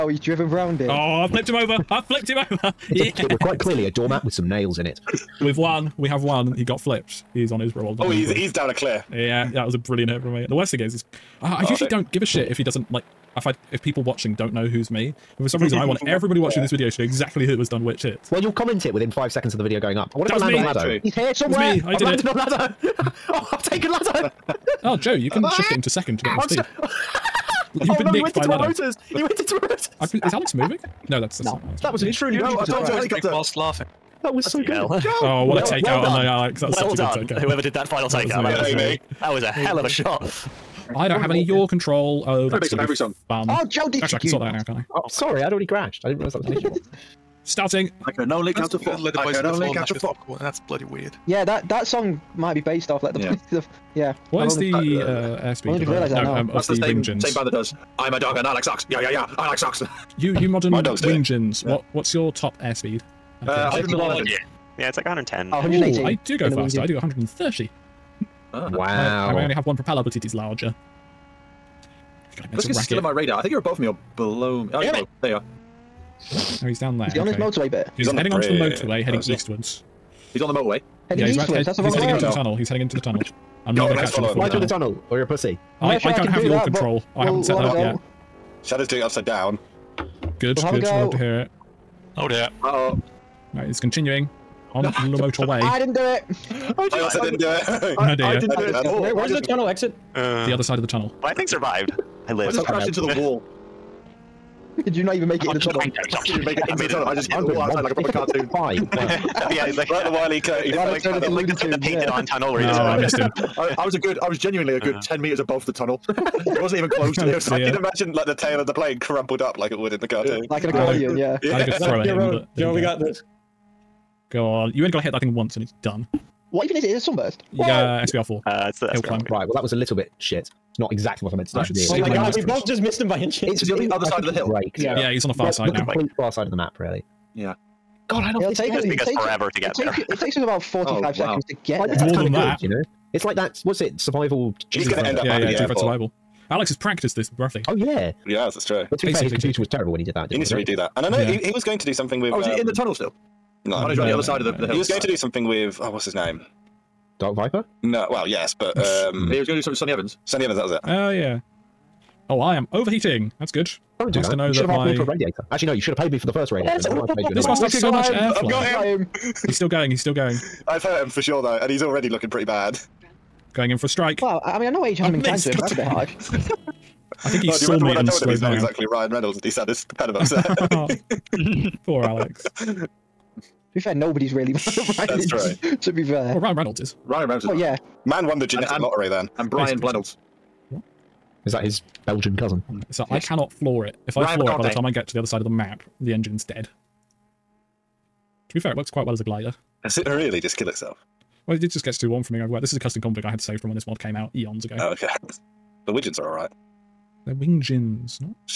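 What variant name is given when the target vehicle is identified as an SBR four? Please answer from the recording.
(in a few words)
Hill 4 Climb.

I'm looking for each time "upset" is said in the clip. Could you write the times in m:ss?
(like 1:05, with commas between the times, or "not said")
3:00.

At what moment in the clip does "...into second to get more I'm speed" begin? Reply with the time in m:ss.
0:25.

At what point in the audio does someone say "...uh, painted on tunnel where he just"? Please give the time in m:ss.
1:51.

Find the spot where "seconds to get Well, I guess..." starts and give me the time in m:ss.
2:21.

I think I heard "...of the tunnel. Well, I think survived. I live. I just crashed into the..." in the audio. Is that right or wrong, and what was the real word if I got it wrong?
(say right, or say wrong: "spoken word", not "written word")
right.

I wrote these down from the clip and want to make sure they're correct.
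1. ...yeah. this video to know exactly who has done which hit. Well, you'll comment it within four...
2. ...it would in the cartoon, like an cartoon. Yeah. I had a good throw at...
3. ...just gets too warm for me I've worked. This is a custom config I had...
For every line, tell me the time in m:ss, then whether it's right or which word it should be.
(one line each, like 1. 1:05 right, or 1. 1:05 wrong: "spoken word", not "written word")
1. 0:16 wrong: "five", not "four"
2. 1:59 wrong: "accordion", not "cartoon"
3. 3:21 right.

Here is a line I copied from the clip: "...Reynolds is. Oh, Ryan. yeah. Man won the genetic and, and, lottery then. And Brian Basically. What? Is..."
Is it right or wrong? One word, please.
wrong.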